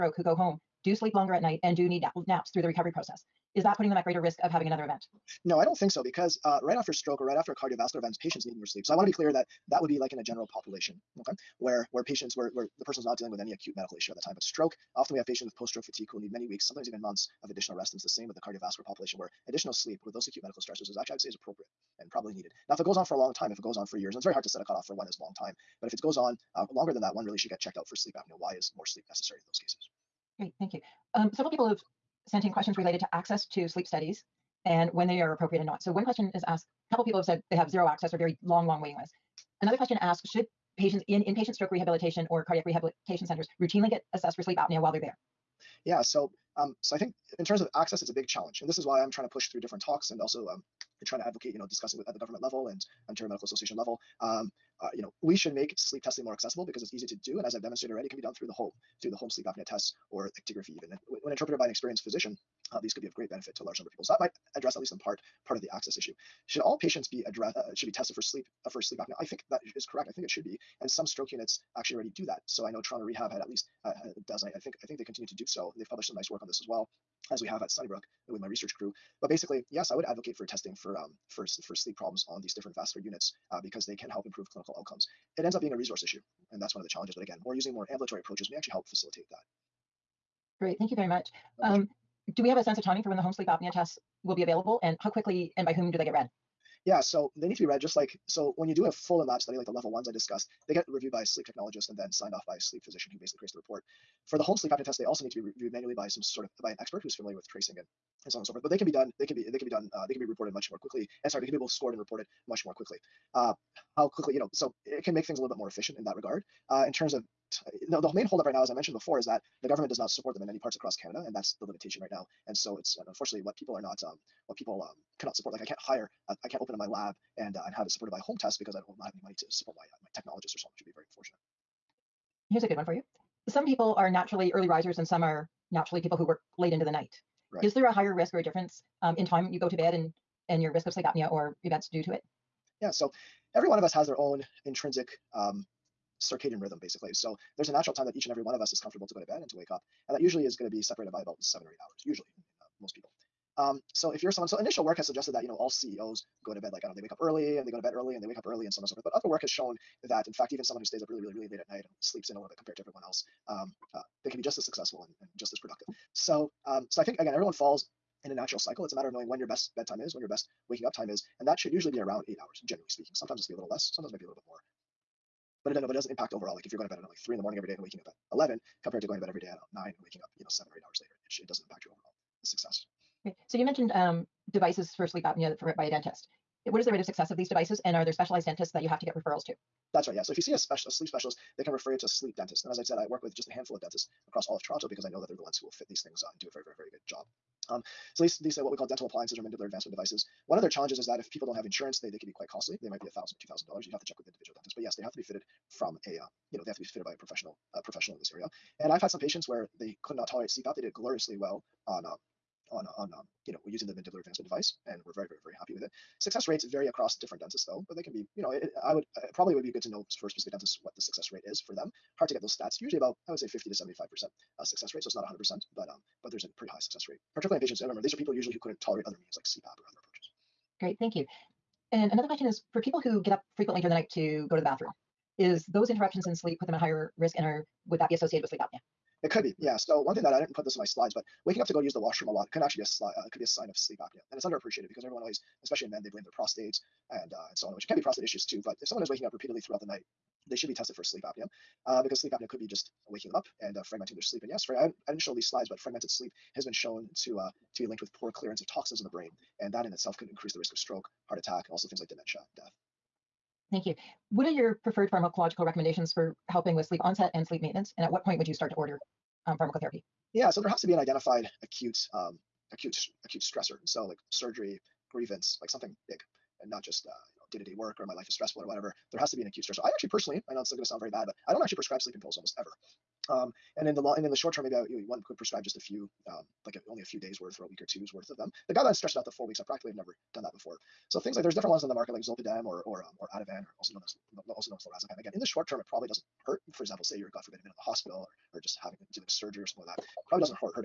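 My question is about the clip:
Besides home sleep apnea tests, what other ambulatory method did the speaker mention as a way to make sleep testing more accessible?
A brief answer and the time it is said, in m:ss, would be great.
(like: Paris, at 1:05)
actigraphy, at 1:00.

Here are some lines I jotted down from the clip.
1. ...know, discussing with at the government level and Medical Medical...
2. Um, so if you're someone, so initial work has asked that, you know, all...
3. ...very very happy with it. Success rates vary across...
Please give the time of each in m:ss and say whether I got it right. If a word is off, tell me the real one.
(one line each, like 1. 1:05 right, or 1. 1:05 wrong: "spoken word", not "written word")
1. 0:51 wrong: "Ontario", not "Medical"
2. 2:33 wrong: "suggested", not "asked"
3. 3:35 right.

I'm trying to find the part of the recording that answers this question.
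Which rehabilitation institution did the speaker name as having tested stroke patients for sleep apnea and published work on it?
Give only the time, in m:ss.
1:12.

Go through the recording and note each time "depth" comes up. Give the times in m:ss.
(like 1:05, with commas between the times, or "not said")
not said.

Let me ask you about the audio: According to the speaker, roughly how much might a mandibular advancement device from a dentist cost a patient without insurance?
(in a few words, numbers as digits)
$1,000 to $2,000.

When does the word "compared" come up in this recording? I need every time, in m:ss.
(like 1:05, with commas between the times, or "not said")
2:42, 2:58.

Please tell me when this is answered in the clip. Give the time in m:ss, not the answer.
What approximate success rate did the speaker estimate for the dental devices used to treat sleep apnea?
3:43.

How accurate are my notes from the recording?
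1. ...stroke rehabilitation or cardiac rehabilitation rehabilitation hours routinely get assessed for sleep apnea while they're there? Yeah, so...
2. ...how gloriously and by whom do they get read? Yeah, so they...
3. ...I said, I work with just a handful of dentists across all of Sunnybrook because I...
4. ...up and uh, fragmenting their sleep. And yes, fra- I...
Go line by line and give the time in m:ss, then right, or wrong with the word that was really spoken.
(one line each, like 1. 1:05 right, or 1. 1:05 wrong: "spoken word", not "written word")
1. 0:41 wrong: "centers", not "hours"
2. 1:34 wrong: "quickly", not "gloriously"
3. 3:12 wrong: "Toronto", not "Sunnybrook"
4. 4:13 right.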